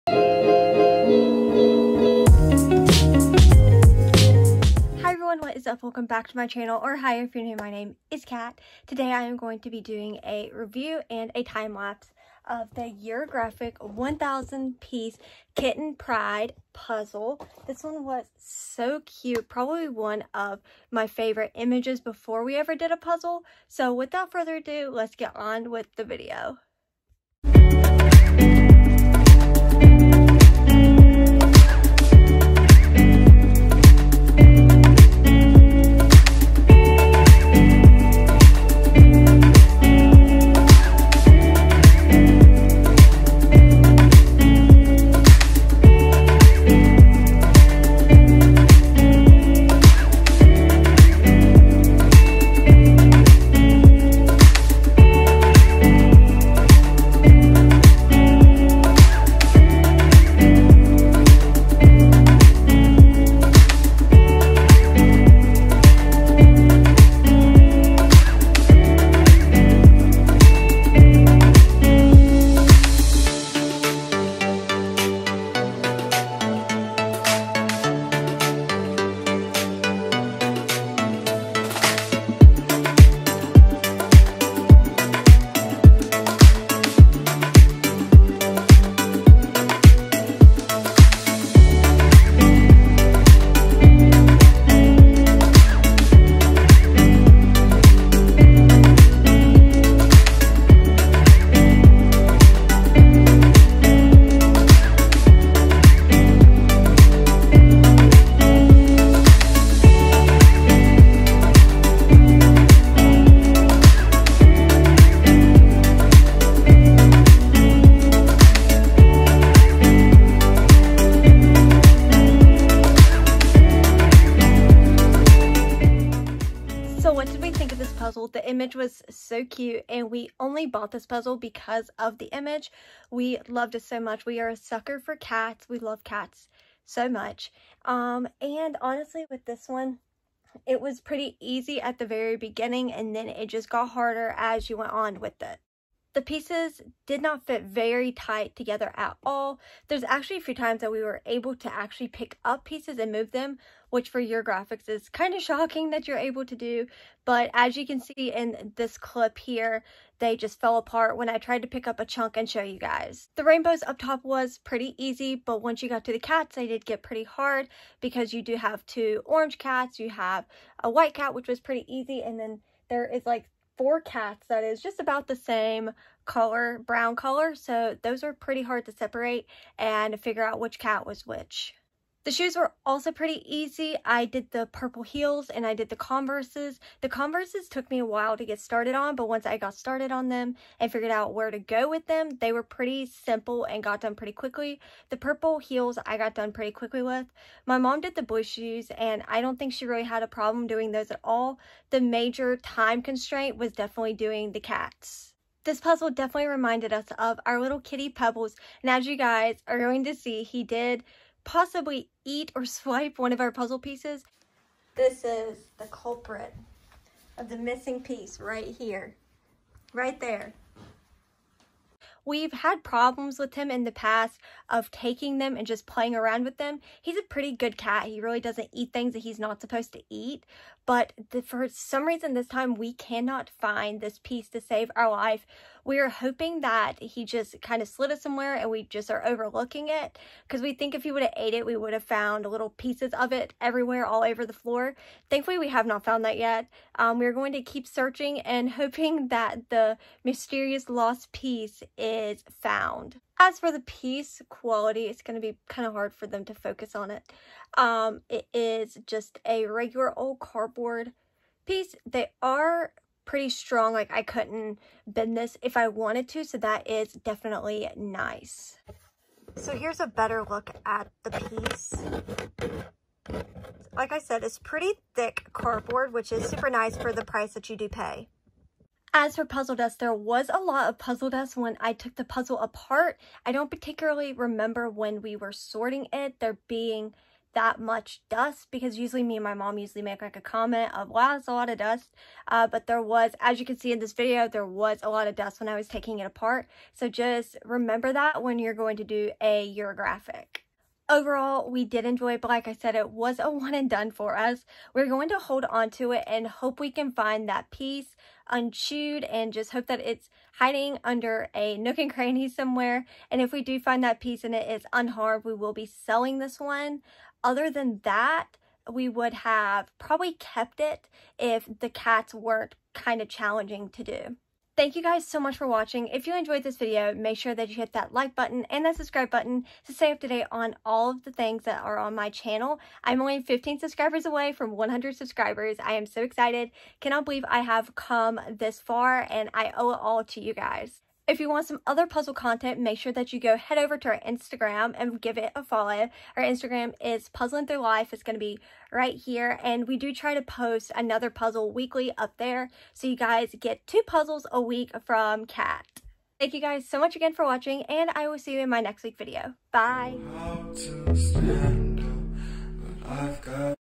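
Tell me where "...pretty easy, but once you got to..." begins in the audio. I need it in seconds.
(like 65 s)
164 s.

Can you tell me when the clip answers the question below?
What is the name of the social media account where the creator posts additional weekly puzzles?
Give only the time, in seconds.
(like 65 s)
347 s.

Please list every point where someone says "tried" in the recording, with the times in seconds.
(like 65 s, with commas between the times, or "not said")
161 s.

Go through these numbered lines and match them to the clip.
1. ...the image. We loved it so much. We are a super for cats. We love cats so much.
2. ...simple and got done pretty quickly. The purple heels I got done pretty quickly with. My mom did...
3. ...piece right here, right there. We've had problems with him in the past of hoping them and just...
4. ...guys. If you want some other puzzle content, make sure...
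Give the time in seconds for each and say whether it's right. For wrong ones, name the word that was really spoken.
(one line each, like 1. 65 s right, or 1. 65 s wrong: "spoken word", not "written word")
1. 132 s wrong: "sucker", not "super"
2. 193 s right
3. 218 s wrong: "taking", not "hoping"
4. 340 s right.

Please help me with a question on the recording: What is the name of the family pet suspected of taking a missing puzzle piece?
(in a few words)
Pebbles.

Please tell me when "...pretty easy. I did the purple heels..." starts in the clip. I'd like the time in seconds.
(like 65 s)
183 s.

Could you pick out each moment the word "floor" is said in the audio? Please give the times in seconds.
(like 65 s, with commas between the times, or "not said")
244 s.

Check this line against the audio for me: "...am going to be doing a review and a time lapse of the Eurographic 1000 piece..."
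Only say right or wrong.
right.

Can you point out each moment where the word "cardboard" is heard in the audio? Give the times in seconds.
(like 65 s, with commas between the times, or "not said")
260 s, 275 s.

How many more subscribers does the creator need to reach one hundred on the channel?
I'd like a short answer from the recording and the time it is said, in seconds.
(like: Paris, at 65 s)
15, at 333 s.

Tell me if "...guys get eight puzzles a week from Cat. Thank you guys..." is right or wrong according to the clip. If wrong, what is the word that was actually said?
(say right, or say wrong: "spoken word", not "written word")
wrong: "two", not "eight".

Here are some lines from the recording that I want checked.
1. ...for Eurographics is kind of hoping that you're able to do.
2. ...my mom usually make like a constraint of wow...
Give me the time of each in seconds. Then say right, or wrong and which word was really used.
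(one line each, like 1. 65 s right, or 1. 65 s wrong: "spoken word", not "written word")
1. 154 s wrong: "shocking", not "hoping"
2. 289 s wrong: "comment", not "constraint".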